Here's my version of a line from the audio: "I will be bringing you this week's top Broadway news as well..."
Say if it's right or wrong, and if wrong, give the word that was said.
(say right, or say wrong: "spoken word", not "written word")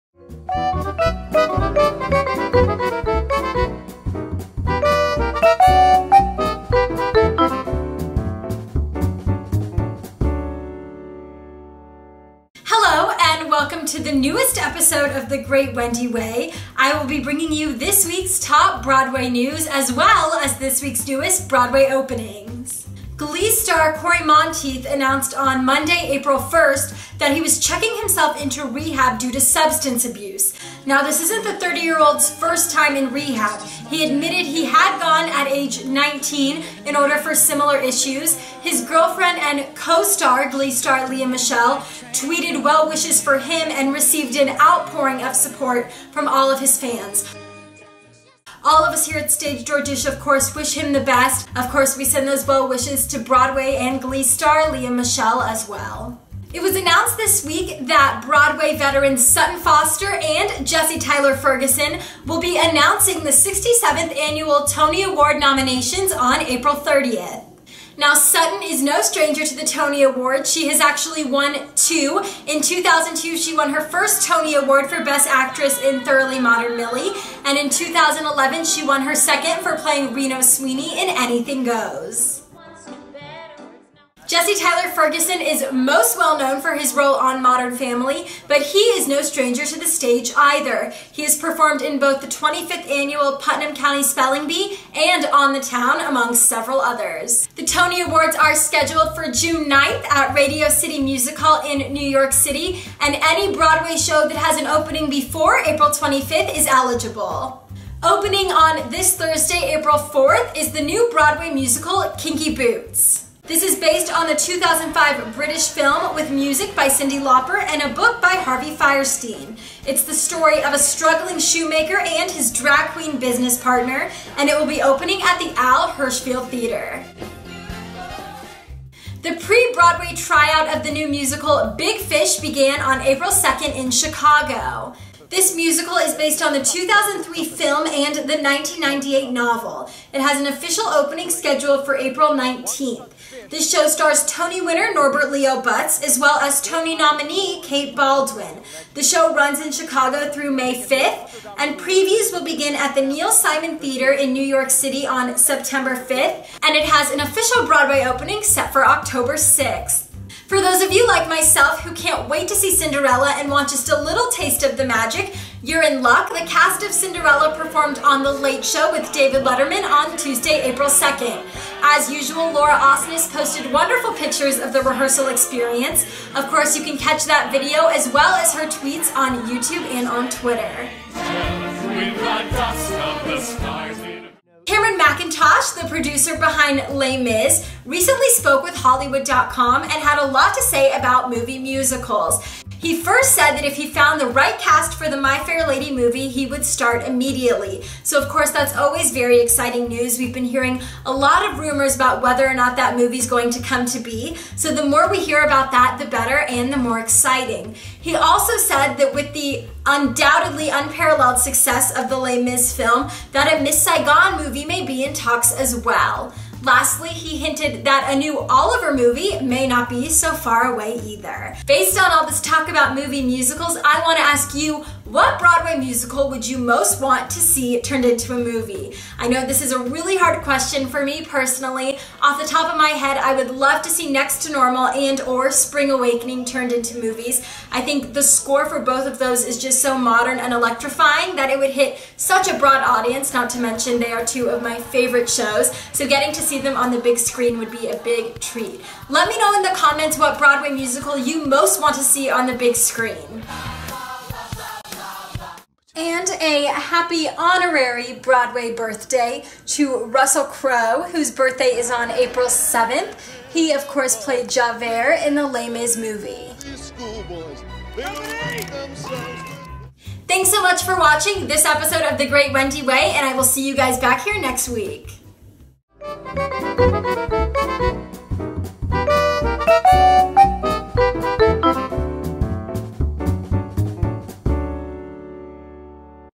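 right.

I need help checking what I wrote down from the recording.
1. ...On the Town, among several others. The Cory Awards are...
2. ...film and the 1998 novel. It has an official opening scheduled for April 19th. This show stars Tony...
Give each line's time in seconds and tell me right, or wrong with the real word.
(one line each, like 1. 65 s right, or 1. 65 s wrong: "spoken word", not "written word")
1. 95 s wrong: "Tony", not "Cory"
2. 137 s right.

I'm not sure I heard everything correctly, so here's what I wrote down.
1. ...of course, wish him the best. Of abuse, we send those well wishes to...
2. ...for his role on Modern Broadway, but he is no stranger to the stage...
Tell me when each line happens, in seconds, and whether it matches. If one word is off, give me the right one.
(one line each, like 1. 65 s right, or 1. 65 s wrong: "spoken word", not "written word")
1. 50 s wrong: "course", not "abuse"
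2. 86 s wrong: "Family", not "Broadway".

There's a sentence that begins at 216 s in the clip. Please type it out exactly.
Lastly, he hinted that a new Oliver movie may not be so far away either.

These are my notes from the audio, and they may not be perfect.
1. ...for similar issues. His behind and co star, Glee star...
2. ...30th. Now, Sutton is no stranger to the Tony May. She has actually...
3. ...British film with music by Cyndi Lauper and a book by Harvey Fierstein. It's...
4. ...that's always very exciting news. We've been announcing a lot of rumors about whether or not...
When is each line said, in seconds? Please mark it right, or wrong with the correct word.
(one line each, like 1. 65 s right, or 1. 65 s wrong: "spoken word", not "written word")
1. 37 s wrong: "girlfriend", not "behind"
2. 66 s wrong: "Award", not "May"
3. 115 s right
4. 198 s wrong: "hearing", not "announcing".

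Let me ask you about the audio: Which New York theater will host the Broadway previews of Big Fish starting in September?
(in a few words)
Neil Simon Theater.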